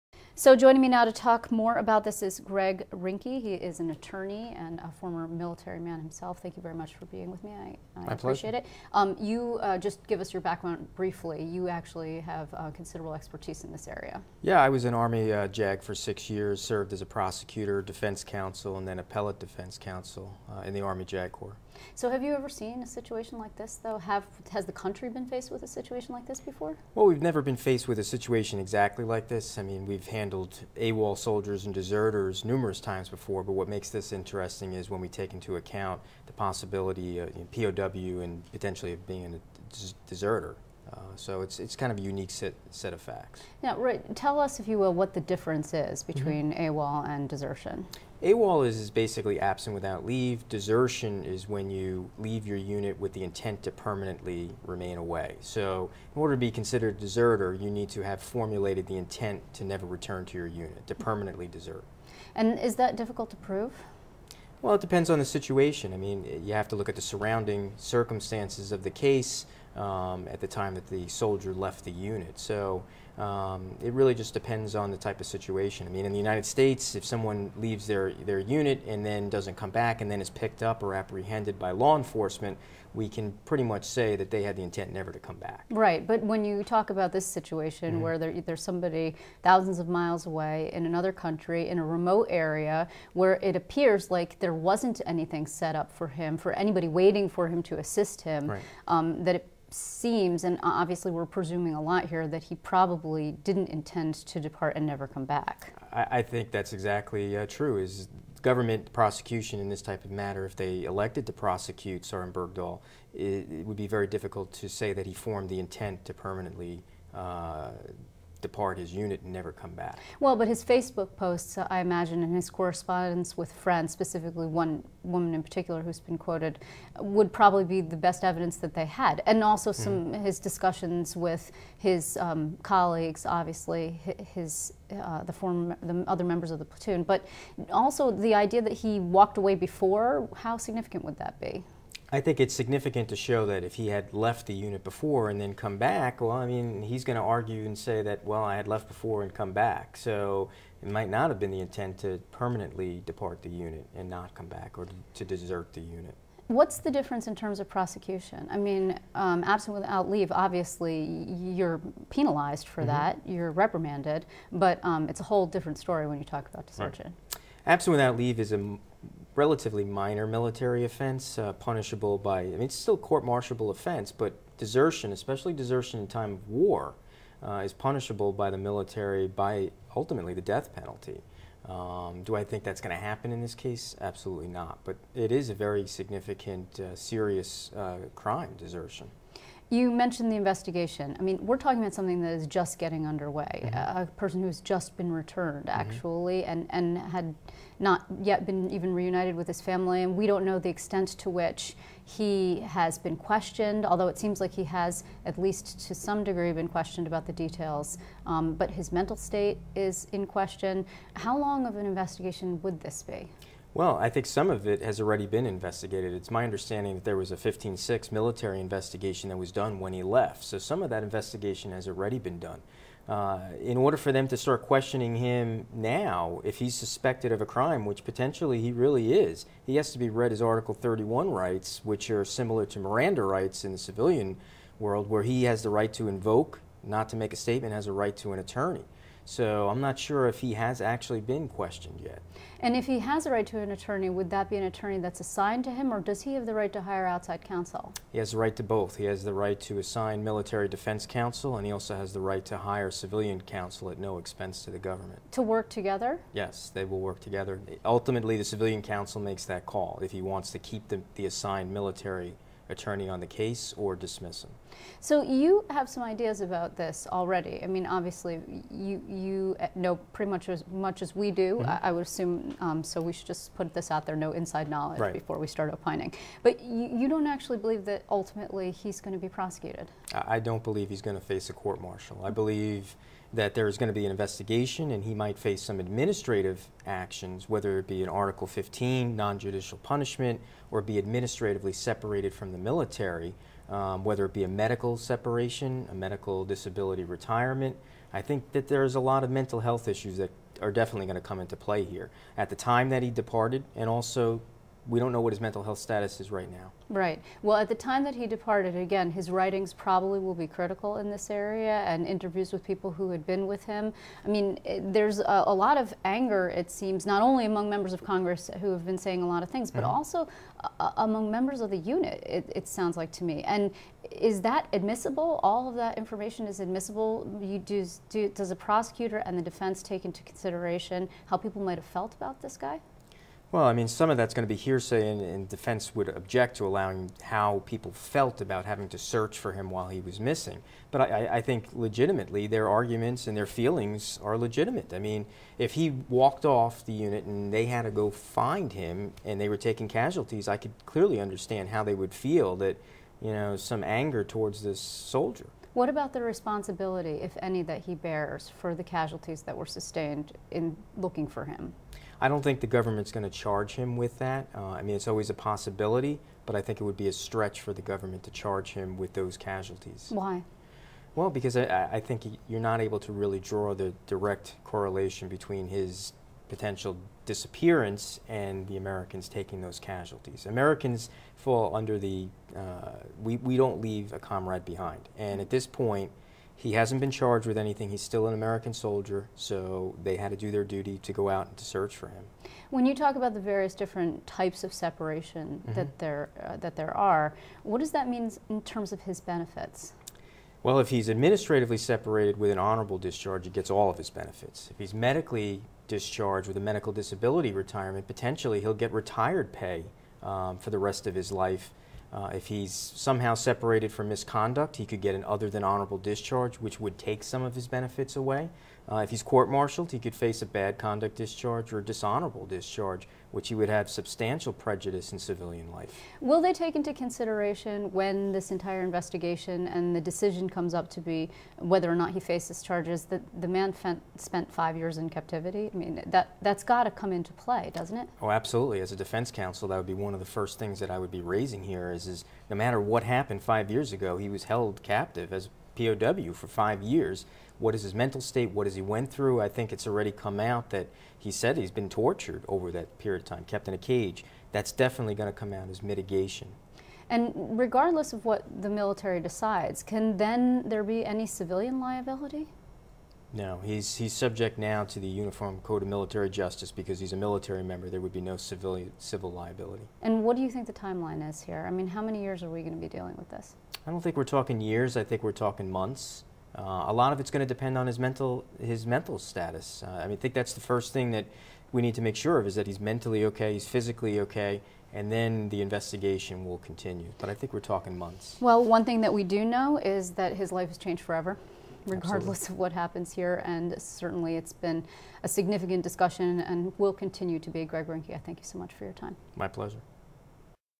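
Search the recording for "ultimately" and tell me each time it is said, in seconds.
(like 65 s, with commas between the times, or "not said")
179 s, 257 s, 278 s.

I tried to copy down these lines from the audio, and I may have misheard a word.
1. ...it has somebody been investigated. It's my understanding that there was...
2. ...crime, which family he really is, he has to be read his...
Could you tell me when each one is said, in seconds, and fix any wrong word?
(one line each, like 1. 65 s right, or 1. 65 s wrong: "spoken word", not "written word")
1. 214 s wrong: "already", not "somebody"
2. 227 s wrong: "potentially", not "family".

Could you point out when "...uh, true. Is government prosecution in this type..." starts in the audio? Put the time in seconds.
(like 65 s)
107 s.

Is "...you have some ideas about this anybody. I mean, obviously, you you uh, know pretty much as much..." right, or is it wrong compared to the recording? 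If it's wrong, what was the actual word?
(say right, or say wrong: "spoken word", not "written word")
wrong: "already", not "anybody".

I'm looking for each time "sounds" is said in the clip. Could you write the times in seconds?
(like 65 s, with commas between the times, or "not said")
322 s.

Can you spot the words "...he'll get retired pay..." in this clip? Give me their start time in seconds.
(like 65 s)
408 s.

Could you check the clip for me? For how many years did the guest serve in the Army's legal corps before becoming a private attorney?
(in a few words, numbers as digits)
6.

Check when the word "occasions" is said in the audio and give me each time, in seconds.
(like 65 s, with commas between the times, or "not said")
not said.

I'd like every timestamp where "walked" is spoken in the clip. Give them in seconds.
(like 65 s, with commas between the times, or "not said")
138 s, 346 s.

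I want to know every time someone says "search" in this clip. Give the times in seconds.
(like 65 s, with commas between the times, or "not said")
338 s, 391 s.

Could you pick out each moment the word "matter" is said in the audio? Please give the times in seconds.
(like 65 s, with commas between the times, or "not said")
110 s, 442 s.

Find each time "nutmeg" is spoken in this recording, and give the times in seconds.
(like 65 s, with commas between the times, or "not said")
not said.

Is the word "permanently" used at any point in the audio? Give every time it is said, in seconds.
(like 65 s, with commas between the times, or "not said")
53 s, 60 s, 116 s, 152 s.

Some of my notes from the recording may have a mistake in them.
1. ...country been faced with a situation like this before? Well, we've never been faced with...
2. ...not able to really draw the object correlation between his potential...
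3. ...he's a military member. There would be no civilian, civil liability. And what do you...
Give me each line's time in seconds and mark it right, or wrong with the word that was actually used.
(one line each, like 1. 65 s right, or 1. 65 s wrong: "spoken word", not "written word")
1. 24 s right
2. 372 s wrong: "direct", not "object"
3. 466 s right.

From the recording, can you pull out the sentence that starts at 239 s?
So I'm not sure if he has actually been questioned yet.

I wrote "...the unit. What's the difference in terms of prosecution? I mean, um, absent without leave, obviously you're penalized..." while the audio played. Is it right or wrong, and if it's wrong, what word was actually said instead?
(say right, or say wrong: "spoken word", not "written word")
right.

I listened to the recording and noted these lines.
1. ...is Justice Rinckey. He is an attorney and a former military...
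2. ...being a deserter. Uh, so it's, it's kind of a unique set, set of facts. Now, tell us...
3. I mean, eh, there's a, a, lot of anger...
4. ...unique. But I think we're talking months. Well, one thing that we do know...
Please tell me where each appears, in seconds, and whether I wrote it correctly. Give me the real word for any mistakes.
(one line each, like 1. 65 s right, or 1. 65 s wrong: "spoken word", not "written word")
1. 2 s wrong: "Greg", not "Justice"
2. 39 s right
3. 314 s right
4. 486 s wrong: "continue", not "unique".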